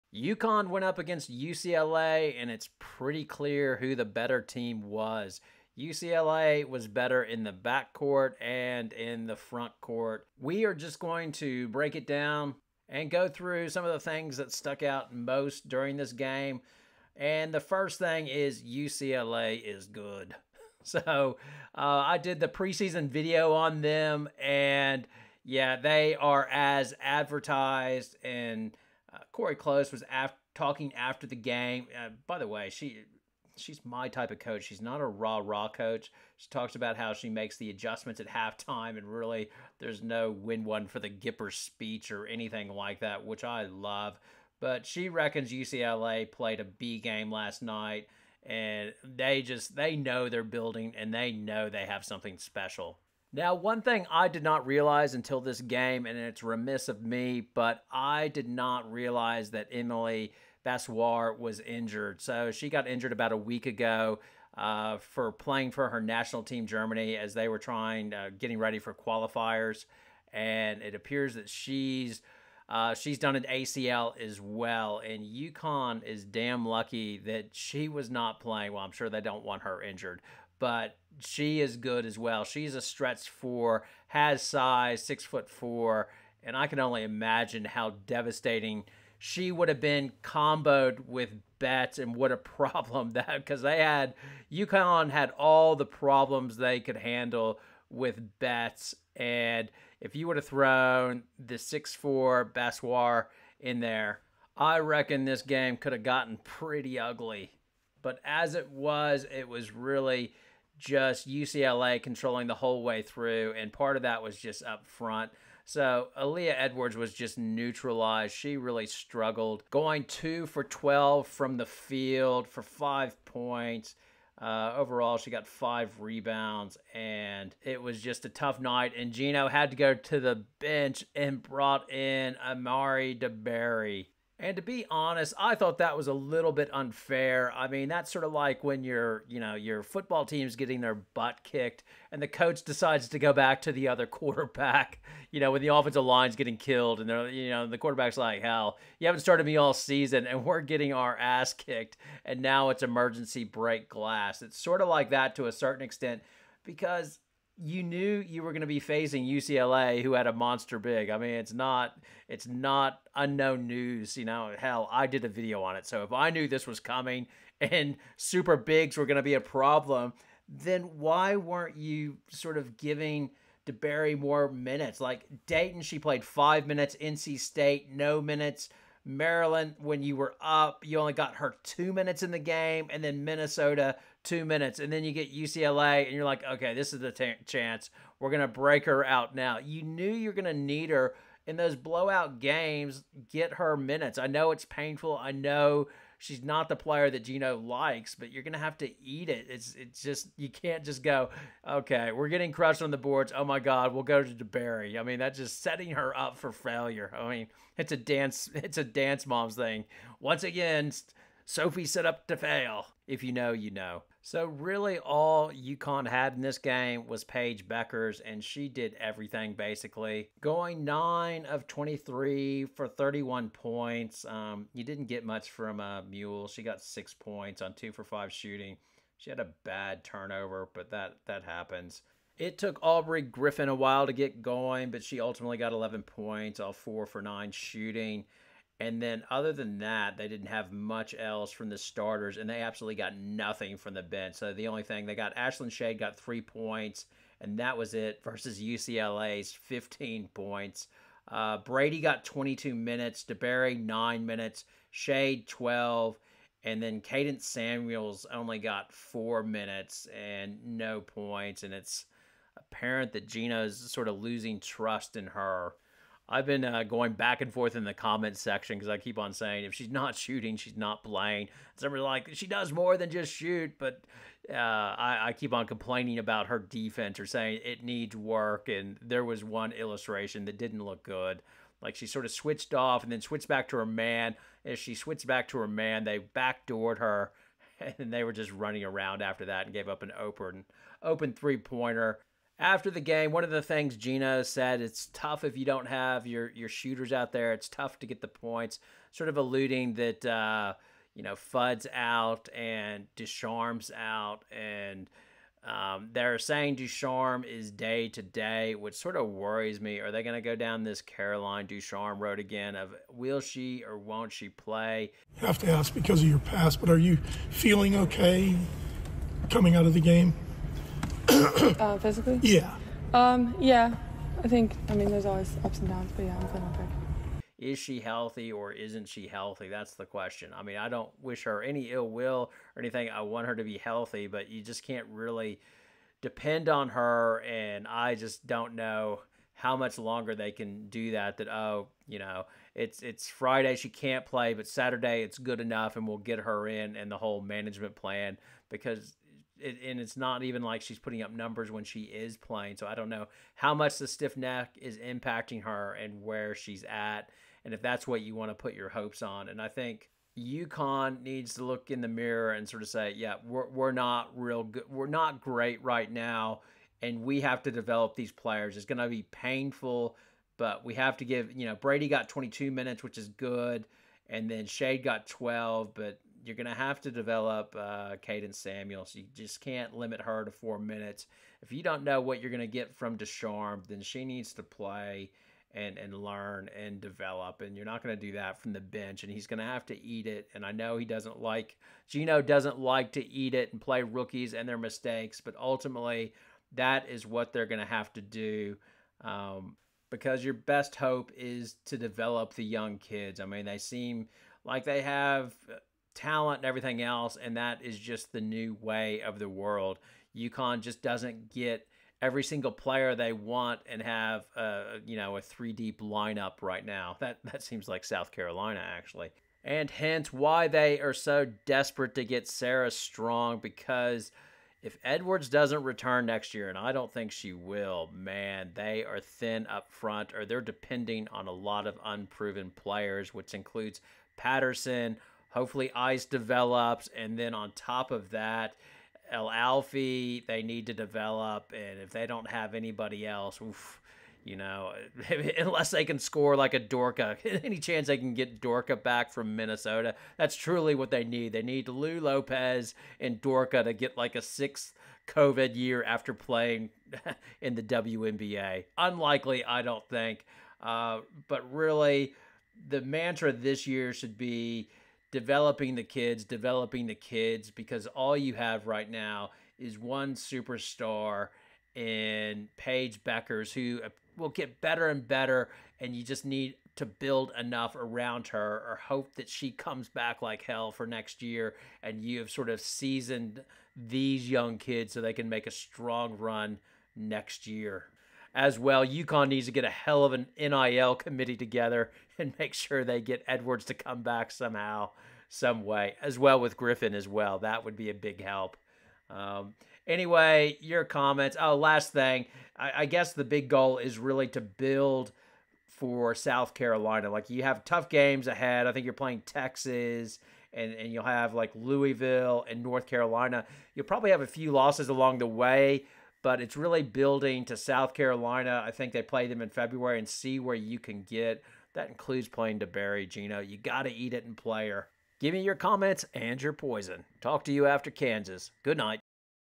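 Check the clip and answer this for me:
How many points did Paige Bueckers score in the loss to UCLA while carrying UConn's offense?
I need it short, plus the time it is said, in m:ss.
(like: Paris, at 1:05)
31, at 3:42.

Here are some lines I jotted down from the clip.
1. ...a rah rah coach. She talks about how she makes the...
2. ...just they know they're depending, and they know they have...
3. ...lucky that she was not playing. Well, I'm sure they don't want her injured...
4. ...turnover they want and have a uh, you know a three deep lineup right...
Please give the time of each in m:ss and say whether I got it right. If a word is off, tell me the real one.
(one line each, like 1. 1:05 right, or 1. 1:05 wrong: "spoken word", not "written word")
1. 0:35 right
2. 0:49 wrong: "building", not "depending"
3. 1:16 right
4. 6:52 wrong: "player", not "turnover".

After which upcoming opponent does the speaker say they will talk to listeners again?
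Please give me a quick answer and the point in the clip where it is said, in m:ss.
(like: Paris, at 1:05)
Kansas, at 8:48.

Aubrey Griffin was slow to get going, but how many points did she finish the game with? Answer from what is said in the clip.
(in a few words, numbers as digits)
11.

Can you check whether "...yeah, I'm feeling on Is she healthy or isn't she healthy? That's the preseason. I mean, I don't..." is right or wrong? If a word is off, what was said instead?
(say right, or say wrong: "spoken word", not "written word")
wrong: "question", not "preseason".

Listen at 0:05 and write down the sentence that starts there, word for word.
UCLA was better in the backcourt and in the front court.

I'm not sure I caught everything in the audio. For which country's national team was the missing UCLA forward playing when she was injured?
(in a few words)
Germany.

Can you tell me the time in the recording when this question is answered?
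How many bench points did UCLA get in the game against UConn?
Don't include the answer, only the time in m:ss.
4:09.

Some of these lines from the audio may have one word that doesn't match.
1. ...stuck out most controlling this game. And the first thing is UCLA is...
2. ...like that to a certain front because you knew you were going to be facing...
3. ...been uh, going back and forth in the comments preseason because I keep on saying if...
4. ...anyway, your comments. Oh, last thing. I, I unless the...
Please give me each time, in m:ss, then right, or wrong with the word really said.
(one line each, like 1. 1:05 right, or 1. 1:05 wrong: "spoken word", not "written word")
1. 0:14 wrong: "during", not "controlling"
2. 2:34 wrong: "extent", not "front"
3. 4:26 wrong: "section", not "preseason"
4. 8:20 wrong: "guess", not "unless".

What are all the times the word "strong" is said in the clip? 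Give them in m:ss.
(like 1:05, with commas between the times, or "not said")
7:02, 8:05.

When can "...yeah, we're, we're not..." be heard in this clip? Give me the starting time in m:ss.
6:03.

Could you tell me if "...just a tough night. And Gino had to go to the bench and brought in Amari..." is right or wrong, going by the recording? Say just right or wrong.
right.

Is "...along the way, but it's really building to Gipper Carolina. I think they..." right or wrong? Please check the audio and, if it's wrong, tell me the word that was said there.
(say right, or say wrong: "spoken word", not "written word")
wrong: "South", not "Gipper".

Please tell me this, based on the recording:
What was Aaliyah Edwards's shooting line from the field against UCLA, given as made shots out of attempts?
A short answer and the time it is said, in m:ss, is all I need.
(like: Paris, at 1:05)
2 for 12, at 2:00.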